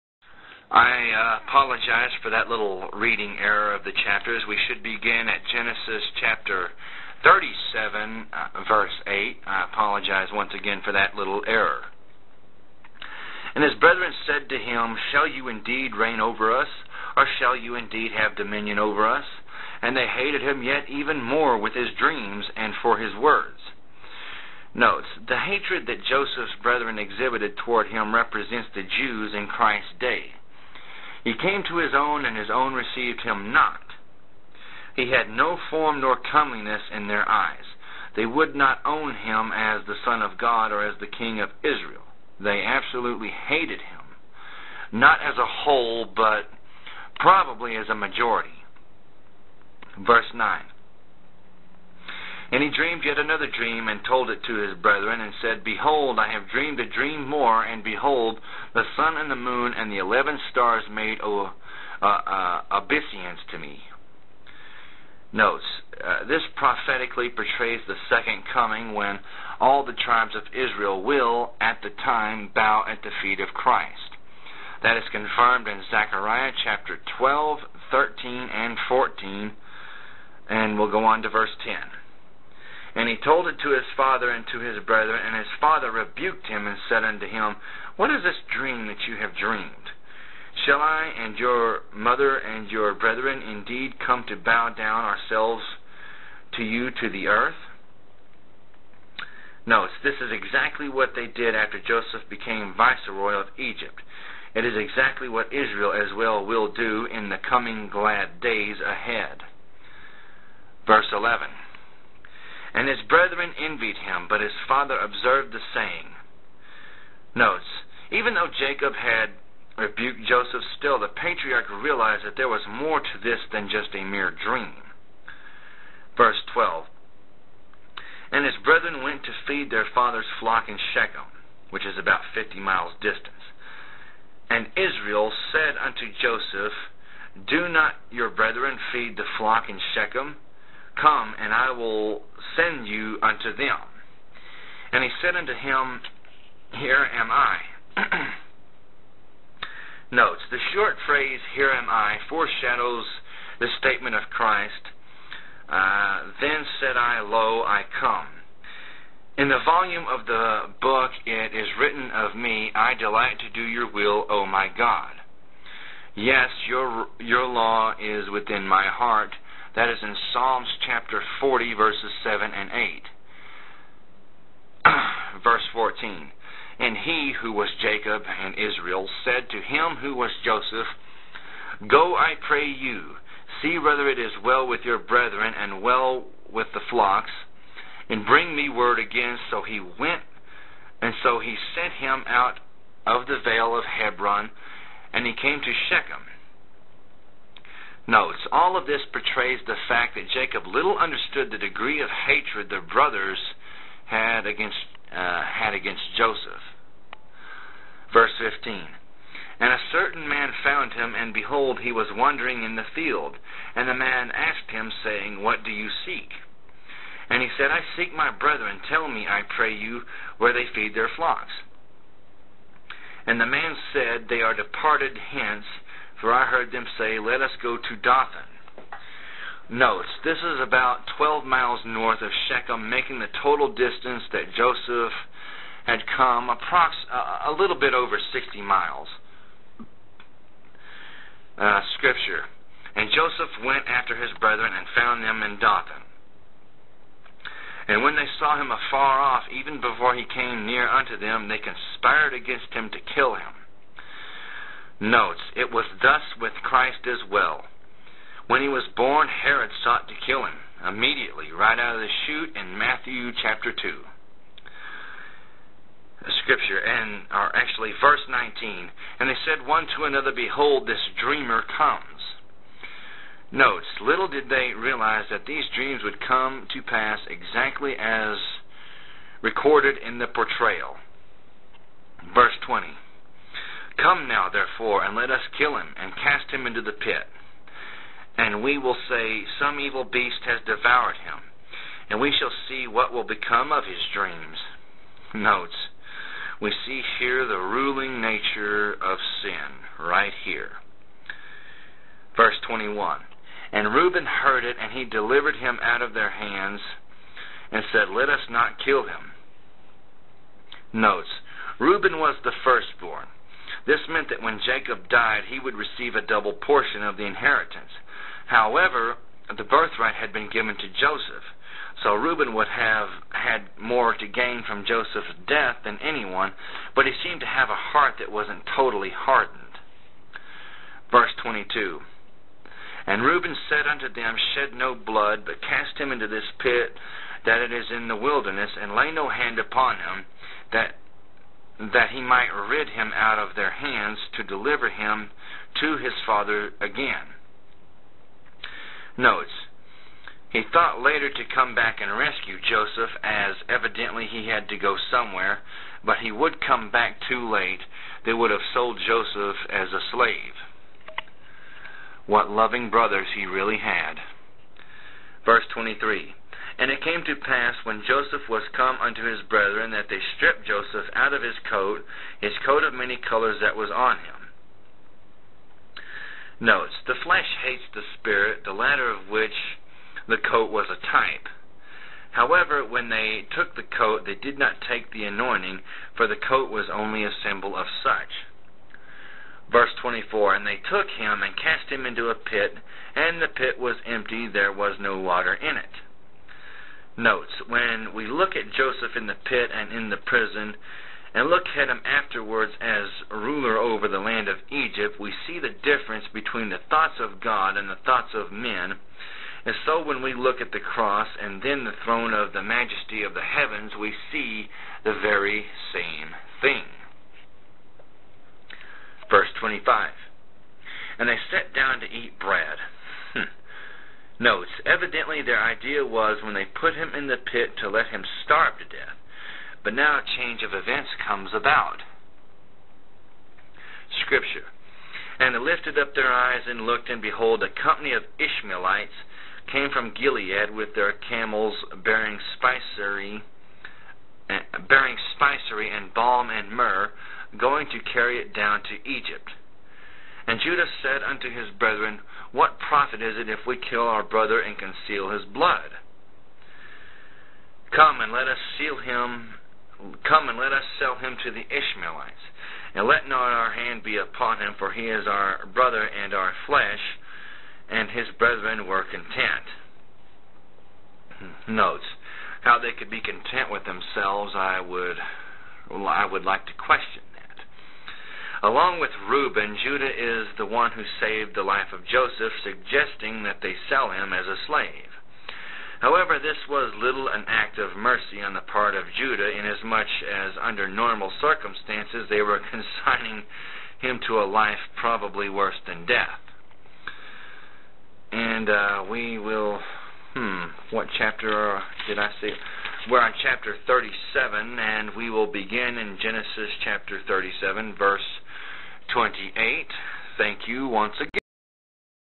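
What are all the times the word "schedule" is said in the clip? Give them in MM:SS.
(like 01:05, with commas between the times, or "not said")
not said.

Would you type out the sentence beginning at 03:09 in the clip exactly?
So he went, and so he sent him out of the vale of Hebron, and he came to Shechem notes.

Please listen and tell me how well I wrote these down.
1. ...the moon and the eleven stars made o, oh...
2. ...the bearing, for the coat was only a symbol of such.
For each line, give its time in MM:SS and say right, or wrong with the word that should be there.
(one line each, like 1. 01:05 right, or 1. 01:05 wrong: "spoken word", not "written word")
1. 00:59 right
2. 06:25 wrong: "anointing", not "bearing".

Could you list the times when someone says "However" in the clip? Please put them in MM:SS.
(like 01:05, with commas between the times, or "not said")
05:18, 06:22, 08:05.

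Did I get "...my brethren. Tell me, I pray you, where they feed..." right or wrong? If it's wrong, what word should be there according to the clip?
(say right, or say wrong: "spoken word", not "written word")
right.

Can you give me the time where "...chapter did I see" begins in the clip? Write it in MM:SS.
08:21.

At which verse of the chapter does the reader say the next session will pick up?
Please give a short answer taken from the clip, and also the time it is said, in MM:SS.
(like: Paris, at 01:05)
Verse 28, at 08:27.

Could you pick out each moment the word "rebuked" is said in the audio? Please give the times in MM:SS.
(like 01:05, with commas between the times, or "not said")
01:25, 01:59.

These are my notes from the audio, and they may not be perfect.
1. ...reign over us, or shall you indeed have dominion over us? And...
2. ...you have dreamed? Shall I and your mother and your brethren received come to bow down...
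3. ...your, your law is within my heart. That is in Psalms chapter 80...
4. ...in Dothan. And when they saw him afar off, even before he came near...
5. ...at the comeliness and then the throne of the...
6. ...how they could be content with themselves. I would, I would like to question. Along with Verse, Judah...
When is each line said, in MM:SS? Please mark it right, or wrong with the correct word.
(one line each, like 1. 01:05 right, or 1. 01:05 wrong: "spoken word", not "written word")
1. 00:15 right
2. 01:29 wrong: "indeed", not "received"
3. 02:46 wrong: "40", not "80"
4. 04:05 right
5. 06:50 wrong: "cross", not "comeliness"
6. 07:52 wrong: "Reuben", not "Verse".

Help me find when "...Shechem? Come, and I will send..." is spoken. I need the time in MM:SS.
02:19.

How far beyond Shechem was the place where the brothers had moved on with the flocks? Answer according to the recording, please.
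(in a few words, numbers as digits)
12 miles.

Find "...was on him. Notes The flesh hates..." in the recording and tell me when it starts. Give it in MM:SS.
06:13.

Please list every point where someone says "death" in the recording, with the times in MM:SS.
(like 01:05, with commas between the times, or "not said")
05:25, 07:08, 08:16.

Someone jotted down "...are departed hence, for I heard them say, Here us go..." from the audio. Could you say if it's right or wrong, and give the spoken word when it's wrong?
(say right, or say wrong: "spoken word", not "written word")
wrong: "Let", not "Here".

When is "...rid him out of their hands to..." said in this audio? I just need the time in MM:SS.
05:42.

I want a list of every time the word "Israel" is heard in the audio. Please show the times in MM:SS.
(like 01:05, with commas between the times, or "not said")
00:41, 01:10, 01:45, 02:14, 02:58.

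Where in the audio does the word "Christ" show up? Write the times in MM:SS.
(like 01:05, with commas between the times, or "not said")
00:29, 01:13, 02:34, 04:16.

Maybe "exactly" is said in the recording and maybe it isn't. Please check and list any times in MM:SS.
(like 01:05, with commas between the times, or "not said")
01:40, 01:44, 04:37.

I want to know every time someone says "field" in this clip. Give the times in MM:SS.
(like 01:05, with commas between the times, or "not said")
03:32.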